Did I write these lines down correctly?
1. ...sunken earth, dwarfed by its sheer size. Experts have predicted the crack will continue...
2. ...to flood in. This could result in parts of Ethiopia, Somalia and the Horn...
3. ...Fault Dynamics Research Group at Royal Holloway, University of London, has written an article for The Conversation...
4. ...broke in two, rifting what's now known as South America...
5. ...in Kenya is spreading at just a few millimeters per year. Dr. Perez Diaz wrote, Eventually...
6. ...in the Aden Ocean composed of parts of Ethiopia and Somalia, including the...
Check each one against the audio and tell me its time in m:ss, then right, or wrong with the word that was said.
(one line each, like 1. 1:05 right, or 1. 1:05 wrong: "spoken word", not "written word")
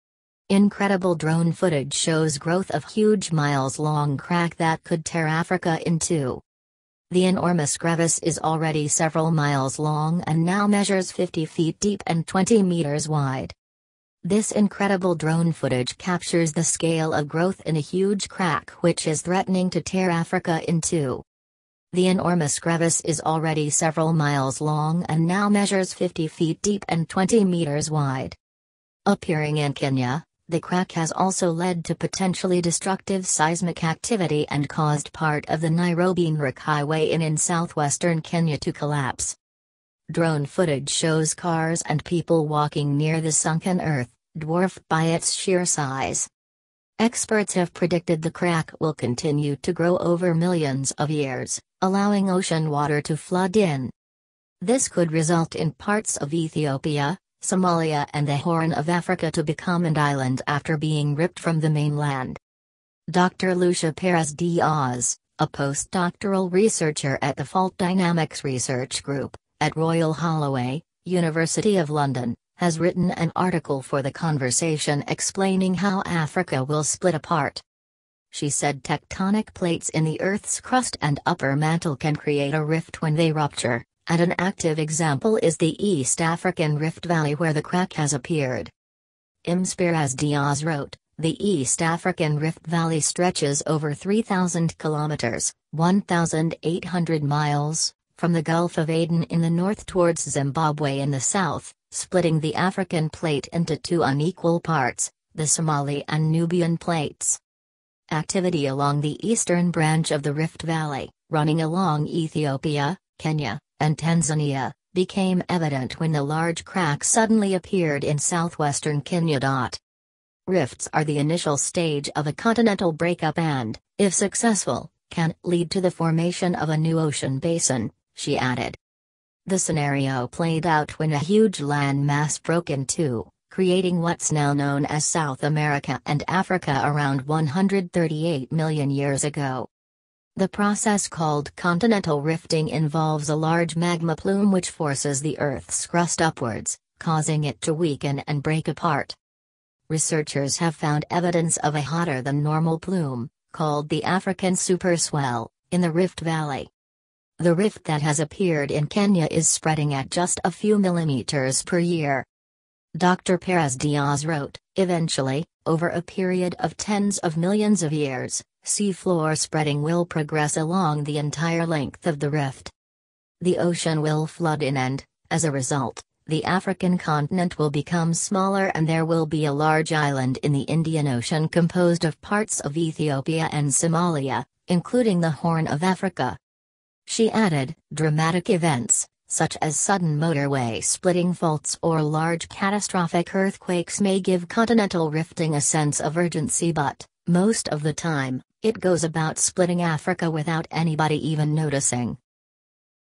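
1. 0:43 right
2. 0:53 right
3. 1:07 right
4. 2:12 wrong: "creating", not "rifting"
5. 2:38 right
6. 3:00 wrong: "Indian", not "Aden".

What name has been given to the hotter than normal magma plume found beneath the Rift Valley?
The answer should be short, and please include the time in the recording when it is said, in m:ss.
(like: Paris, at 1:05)
African superswell, at 2:34.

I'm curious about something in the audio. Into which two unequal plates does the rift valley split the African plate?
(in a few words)
Somali and Nubian.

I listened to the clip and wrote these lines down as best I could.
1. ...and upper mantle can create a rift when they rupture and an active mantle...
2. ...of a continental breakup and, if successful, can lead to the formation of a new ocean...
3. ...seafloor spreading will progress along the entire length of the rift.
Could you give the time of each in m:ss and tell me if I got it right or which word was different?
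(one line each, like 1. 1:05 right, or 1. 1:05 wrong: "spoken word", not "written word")
1. 1:21 wrong: "example", not "mantle"
2. 2:02 right
3. 2:48 right.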